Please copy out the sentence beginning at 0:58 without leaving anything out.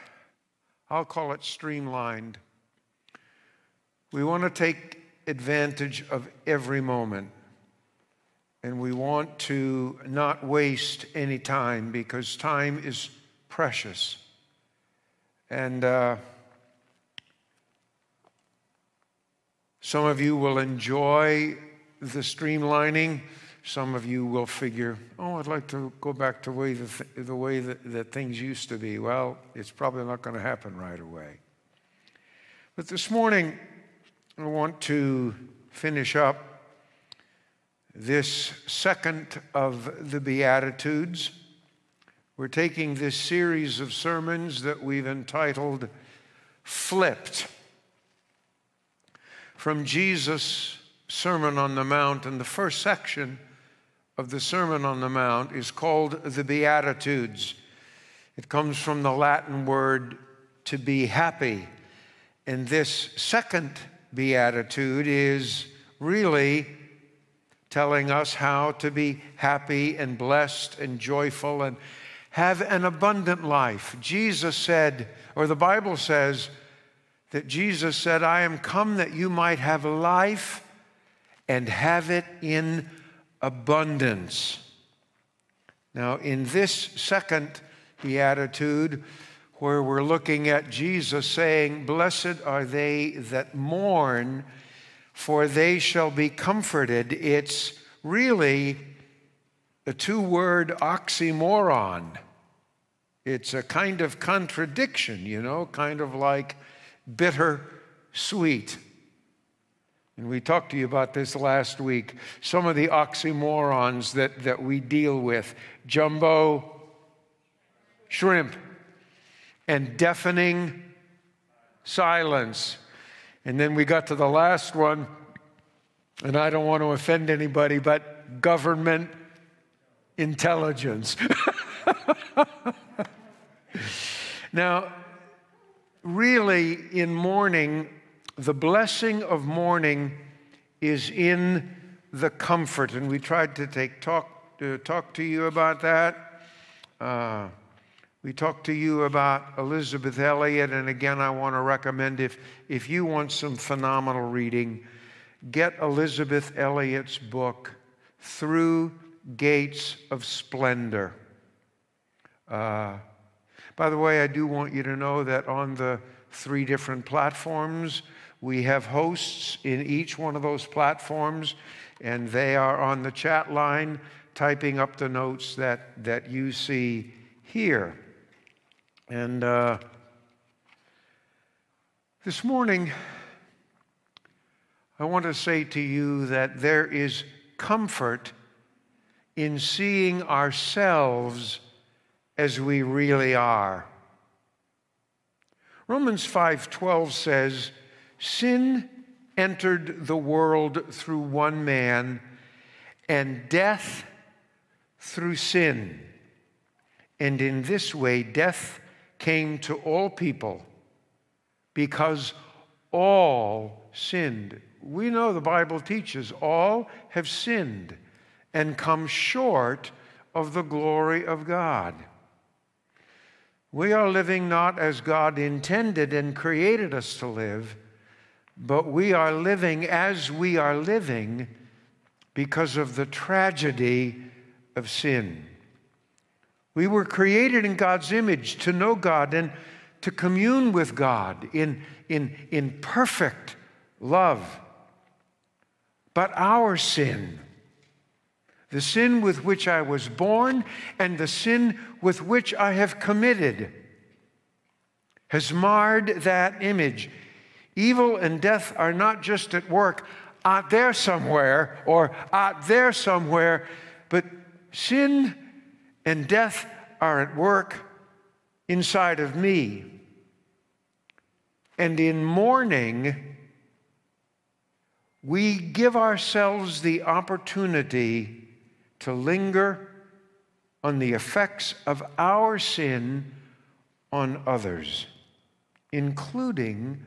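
It comes from the Latin word to be happy.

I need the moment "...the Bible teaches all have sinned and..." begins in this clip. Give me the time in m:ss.
3:35.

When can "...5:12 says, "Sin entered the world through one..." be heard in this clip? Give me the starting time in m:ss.
3:16.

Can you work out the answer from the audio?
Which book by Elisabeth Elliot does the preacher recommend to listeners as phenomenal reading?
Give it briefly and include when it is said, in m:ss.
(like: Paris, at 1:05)
Through Gates of Splendor, at 2:38.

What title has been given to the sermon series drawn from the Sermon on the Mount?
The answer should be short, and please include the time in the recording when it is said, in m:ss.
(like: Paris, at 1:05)
Flipped, at 0:46.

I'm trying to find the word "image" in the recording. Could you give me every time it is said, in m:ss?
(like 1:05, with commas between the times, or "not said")
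3:58, 4:16.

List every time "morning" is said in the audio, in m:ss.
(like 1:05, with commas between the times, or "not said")
0:33, 3:02.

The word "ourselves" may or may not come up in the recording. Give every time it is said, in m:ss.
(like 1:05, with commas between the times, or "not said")
3:10, 4:35.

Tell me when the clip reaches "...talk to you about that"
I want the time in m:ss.
2:24.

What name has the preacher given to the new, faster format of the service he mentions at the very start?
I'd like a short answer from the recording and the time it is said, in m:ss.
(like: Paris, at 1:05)
Streamlined, at 0:01.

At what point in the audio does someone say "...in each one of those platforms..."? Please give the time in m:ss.
2:49.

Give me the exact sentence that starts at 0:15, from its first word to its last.
And uh, some of you will enjoy the streamlining.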